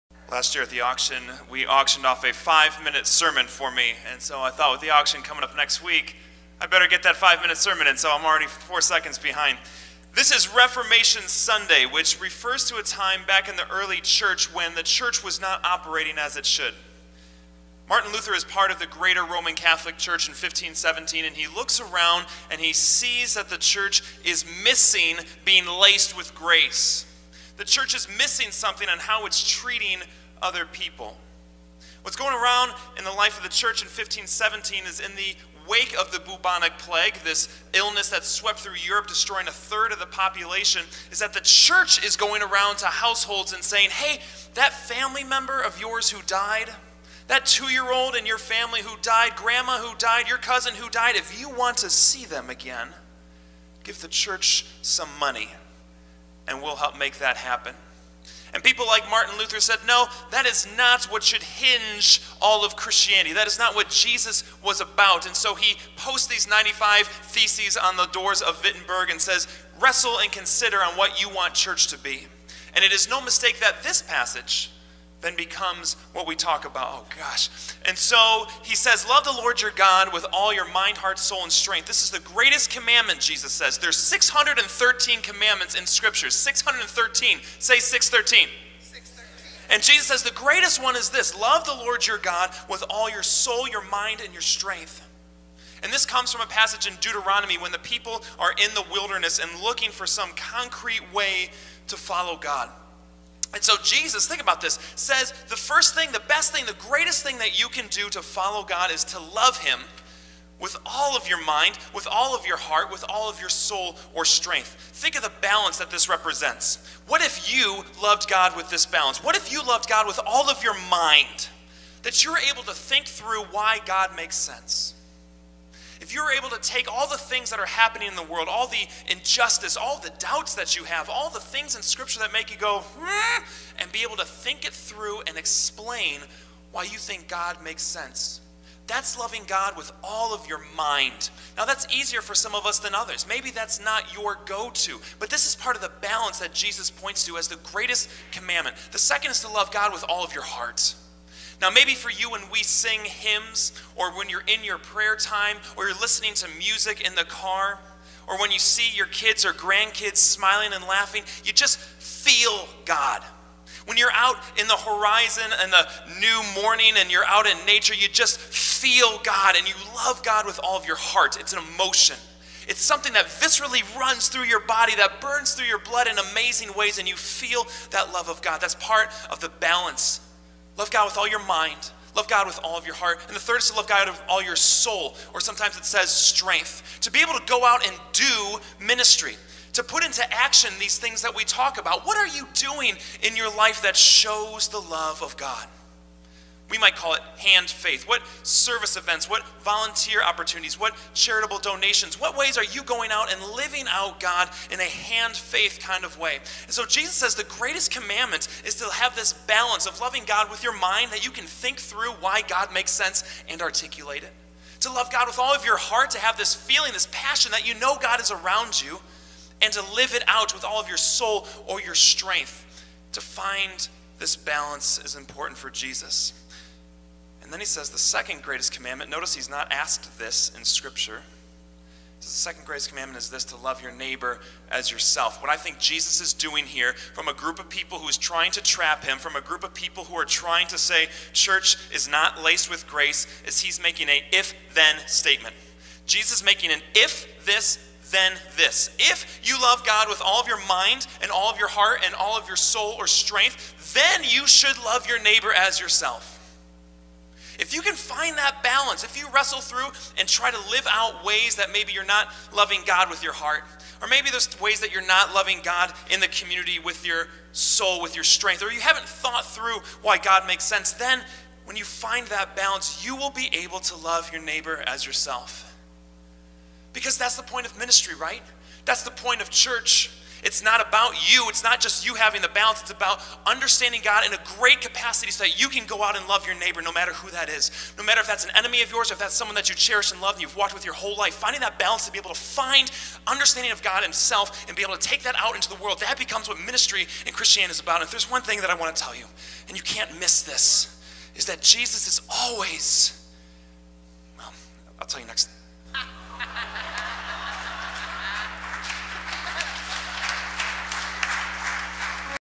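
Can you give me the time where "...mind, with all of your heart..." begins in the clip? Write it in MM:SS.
01:51.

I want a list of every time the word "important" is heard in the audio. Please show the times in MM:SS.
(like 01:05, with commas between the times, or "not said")
03:45.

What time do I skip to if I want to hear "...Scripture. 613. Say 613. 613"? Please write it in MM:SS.
01:25.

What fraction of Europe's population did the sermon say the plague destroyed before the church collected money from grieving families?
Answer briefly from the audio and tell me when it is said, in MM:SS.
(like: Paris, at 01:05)
a third, at 00:39.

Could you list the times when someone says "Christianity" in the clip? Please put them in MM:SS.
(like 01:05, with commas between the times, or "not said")
01:02, 04:57.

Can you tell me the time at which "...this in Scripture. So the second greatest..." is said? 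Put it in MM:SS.
03:50.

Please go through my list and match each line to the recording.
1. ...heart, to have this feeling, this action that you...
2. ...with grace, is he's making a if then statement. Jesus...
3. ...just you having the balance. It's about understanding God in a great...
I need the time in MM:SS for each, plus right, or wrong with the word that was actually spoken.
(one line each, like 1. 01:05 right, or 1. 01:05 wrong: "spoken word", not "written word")
1. 03:35 wrong: "passion", not "action"
2. 04:02 right
3. 04:41 right.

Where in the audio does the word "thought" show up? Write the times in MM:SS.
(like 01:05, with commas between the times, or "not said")
00:04, 04:29.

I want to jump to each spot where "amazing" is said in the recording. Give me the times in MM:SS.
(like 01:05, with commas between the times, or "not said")
02:56.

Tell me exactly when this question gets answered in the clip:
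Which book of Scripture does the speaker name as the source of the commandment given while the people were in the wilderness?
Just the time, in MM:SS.
01:36.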